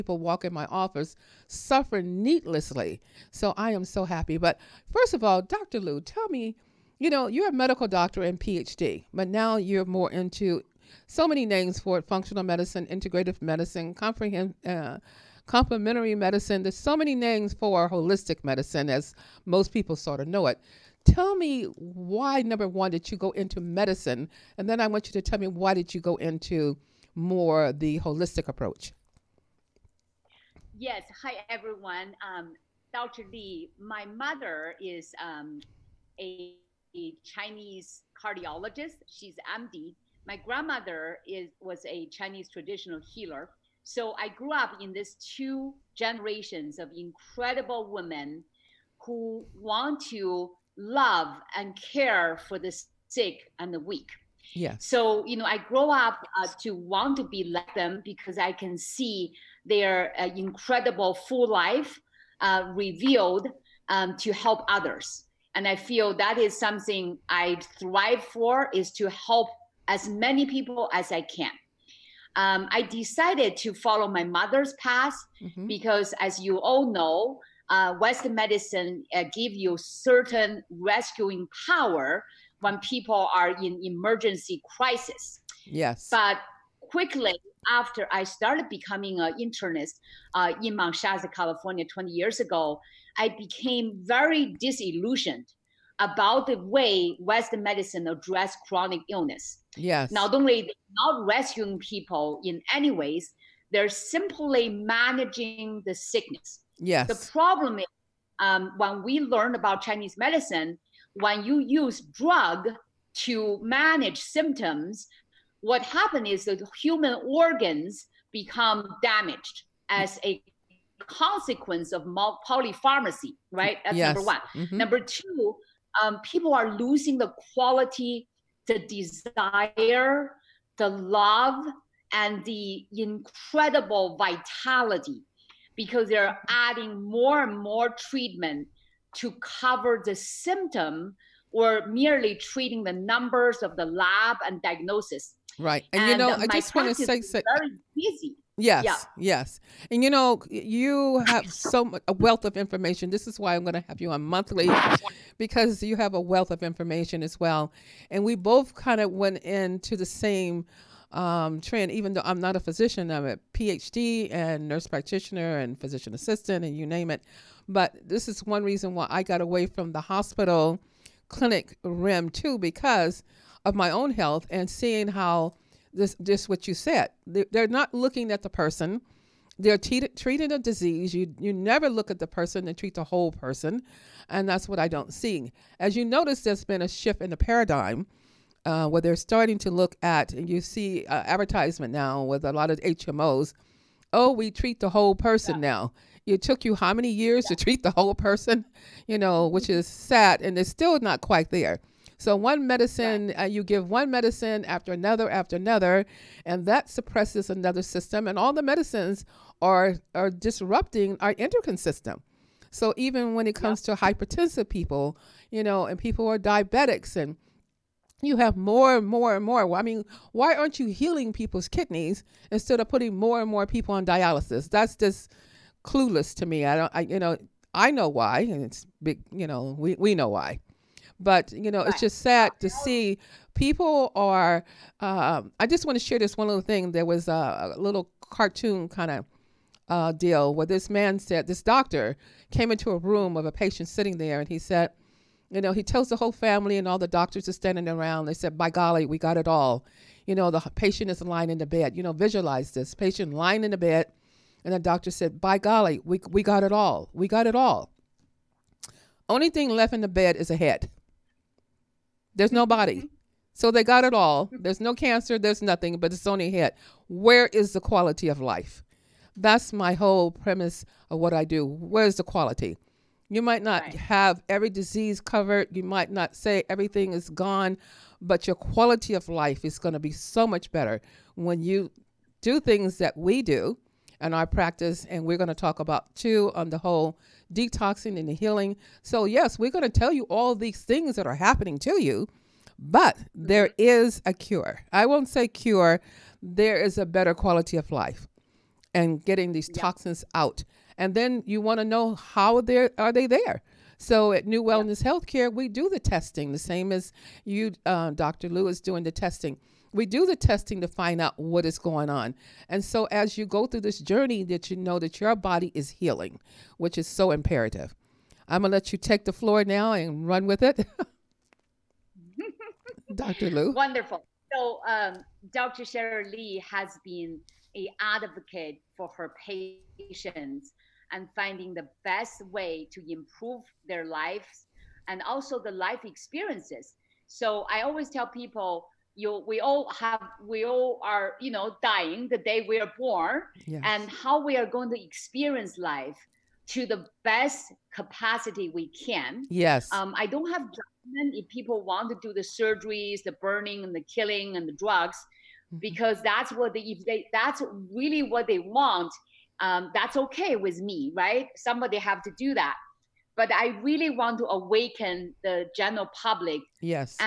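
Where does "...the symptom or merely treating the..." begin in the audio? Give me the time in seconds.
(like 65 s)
140 s.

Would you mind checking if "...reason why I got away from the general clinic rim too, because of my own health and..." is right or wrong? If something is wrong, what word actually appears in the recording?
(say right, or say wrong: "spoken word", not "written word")
wrong: "hospital", not "general".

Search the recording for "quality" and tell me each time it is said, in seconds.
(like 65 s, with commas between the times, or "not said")
127 s, 267 s, 272 s, 278 s, 297 s.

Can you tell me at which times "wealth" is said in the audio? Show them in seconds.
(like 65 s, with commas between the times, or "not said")
152 s, 156 s.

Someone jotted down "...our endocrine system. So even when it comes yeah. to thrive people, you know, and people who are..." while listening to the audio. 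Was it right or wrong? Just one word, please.
wrong.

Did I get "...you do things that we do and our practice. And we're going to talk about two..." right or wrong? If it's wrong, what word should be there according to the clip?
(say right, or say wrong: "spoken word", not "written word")
right.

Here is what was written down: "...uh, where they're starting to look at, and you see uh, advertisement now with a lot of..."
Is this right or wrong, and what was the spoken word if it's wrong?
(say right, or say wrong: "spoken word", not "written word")
right.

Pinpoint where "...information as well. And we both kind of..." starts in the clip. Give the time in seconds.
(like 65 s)
156 s.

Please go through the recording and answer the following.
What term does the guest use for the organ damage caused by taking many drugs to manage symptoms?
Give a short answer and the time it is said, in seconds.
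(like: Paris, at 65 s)
Polypharmacy, at 122 s.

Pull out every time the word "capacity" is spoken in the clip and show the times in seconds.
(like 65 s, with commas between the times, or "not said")
347 s.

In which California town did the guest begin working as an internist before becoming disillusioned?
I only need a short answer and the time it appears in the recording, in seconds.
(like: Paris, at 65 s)
Mount Shasta, at 90 s.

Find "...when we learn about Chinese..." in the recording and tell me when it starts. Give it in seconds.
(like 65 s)
108 s.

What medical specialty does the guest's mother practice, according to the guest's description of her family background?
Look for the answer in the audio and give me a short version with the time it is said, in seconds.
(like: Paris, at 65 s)
Cardiologist, at 38 s.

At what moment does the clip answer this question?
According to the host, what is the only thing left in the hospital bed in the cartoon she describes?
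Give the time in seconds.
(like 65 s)
260 s.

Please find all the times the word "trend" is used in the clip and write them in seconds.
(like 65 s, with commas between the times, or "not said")
161 s.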